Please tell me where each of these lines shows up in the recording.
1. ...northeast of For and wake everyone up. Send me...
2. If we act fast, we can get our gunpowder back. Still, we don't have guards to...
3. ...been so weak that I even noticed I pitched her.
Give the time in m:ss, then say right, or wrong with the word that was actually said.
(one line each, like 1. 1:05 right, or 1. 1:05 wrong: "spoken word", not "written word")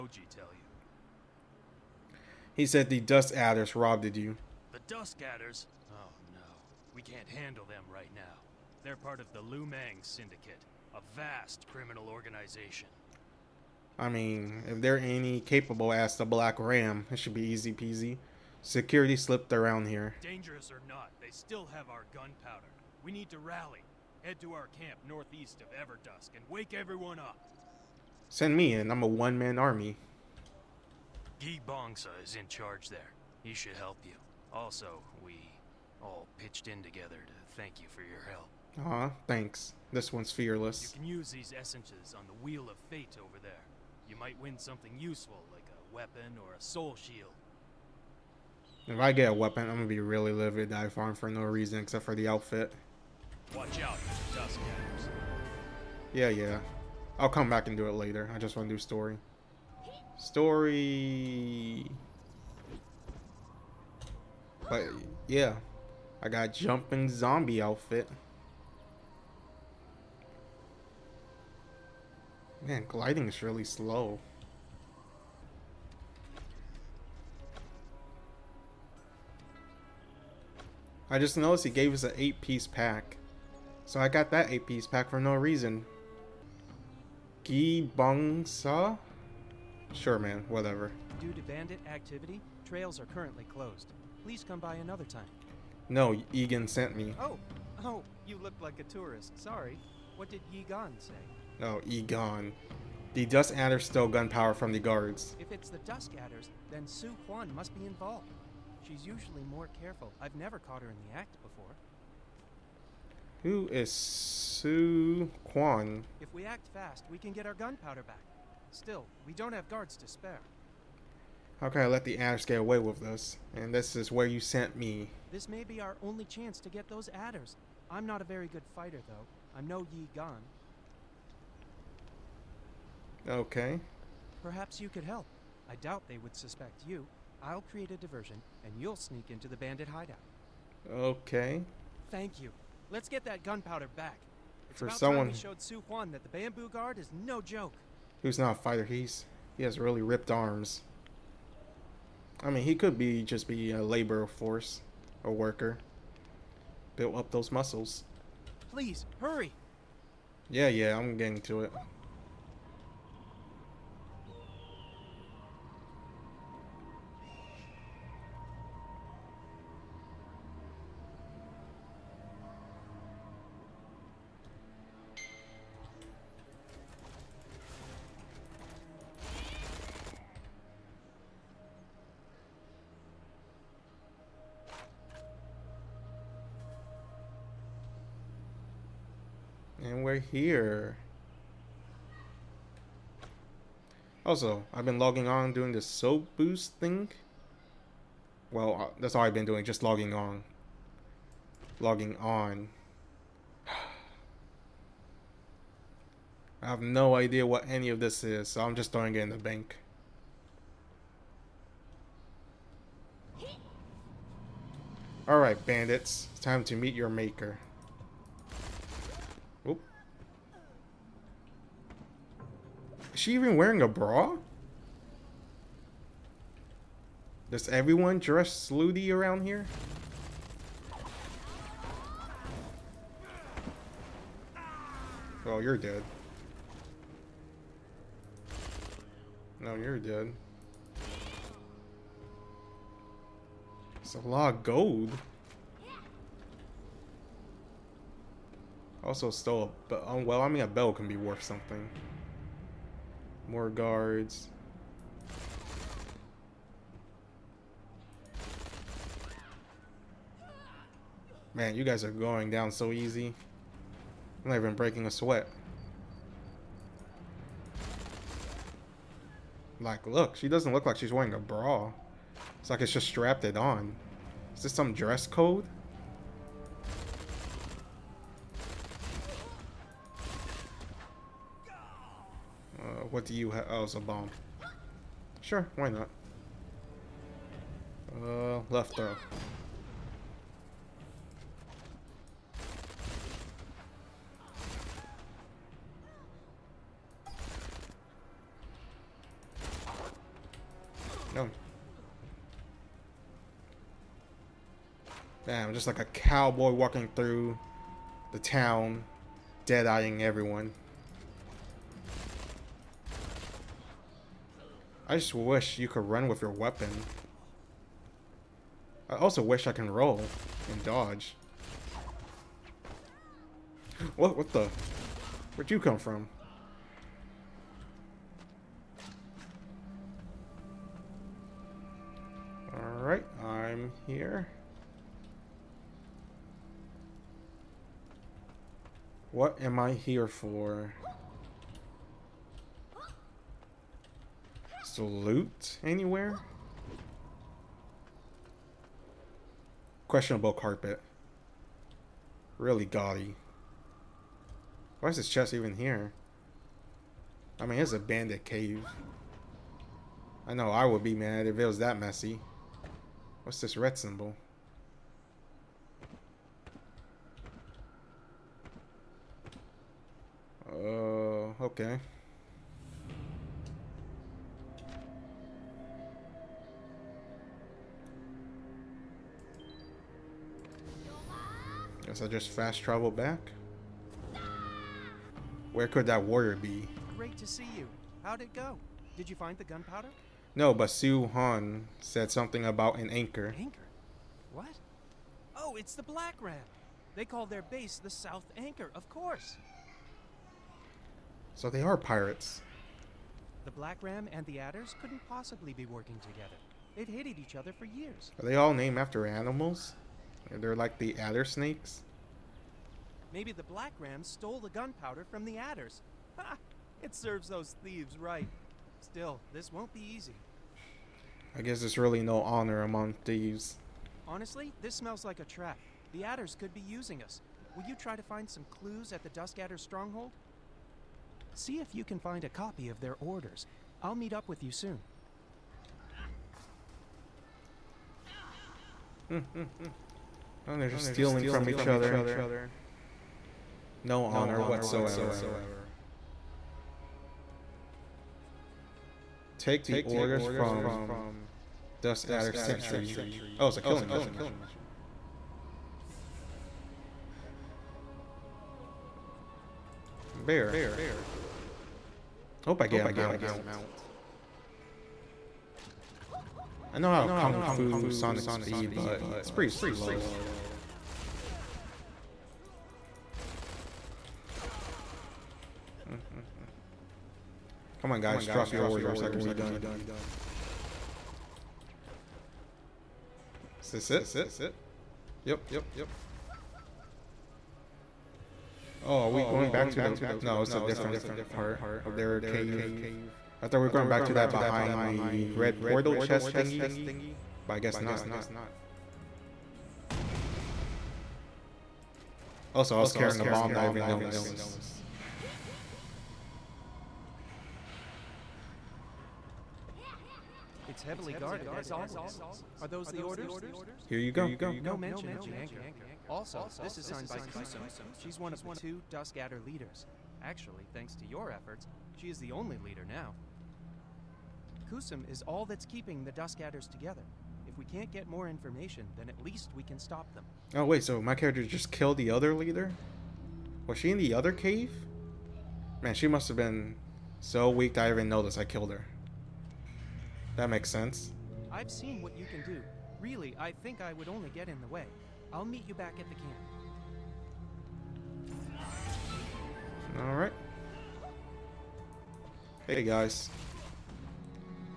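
1. 0:25 wrong: "Everdusk", not "For"
2. 1:56 right
3. 8:56 wrong: "killed", not "pitched".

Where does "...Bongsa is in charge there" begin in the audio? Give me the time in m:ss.
0:31.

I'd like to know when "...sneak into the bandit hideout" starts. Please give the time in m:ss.
2:18.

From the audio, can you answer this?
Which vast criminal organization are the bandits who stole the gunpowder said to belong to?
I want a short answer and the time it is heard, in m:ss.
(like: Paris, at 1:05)
Lu Mang Syndicate, at 0:09.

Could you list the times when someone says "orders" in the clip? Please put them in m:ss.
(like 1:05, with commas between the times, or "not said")
7:13, 7:30, 7:58, 8:33.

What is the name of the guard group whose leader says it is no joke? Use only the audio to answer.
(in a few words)
Bamboo guard.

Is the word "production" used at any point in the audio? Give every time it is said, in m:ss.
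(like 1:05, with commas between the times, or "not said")
not said.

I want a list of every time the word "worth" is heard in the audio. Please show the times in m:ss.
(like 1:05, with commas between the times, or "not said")
4:11.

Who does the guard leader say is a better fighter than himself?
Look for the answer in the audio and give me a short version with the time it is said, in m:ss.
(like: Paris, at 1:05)
Yi Gan, at 2:09.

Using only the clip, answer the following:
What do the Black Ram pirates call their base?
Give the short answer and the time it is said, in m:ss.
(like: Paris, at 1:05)
South Anchor, at 6:38.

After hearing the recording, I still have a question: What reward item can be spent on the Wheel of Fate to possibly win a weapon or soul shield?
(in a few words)
Essences.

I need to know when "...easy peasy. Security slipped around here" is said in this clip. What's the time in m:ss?
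0:17.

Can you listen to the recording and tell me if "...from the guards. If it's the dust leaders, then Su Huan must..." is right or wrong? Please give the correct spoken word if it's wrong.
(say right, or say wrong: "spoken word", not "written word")
wrong: "adders", not "leaders".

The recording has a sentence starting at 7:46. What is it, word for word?
I know how Kung Fu Sonic Speed, but it's pretty slow.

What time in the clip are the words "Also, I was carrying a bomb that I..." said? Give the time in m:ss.
8:22.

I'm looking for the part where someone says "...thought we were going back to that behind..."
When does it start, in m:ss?
8:13.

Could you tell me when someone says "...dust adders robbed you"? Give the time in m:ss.
0:03.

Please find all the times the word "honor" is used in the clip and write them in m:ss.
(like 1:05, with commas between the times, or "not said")
7:02, 7:24.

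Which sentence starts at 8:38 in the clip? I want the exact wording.
She's one of the two Dusk Adder leaders.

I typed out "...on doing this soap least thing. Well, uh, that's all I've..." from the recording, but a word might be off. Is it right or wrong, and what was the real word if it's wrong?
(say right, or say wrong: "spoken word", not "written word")
wrong: "boost", not "least".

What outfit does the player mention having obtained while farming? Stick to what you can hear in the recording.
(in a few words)
Jumping zombie outfit.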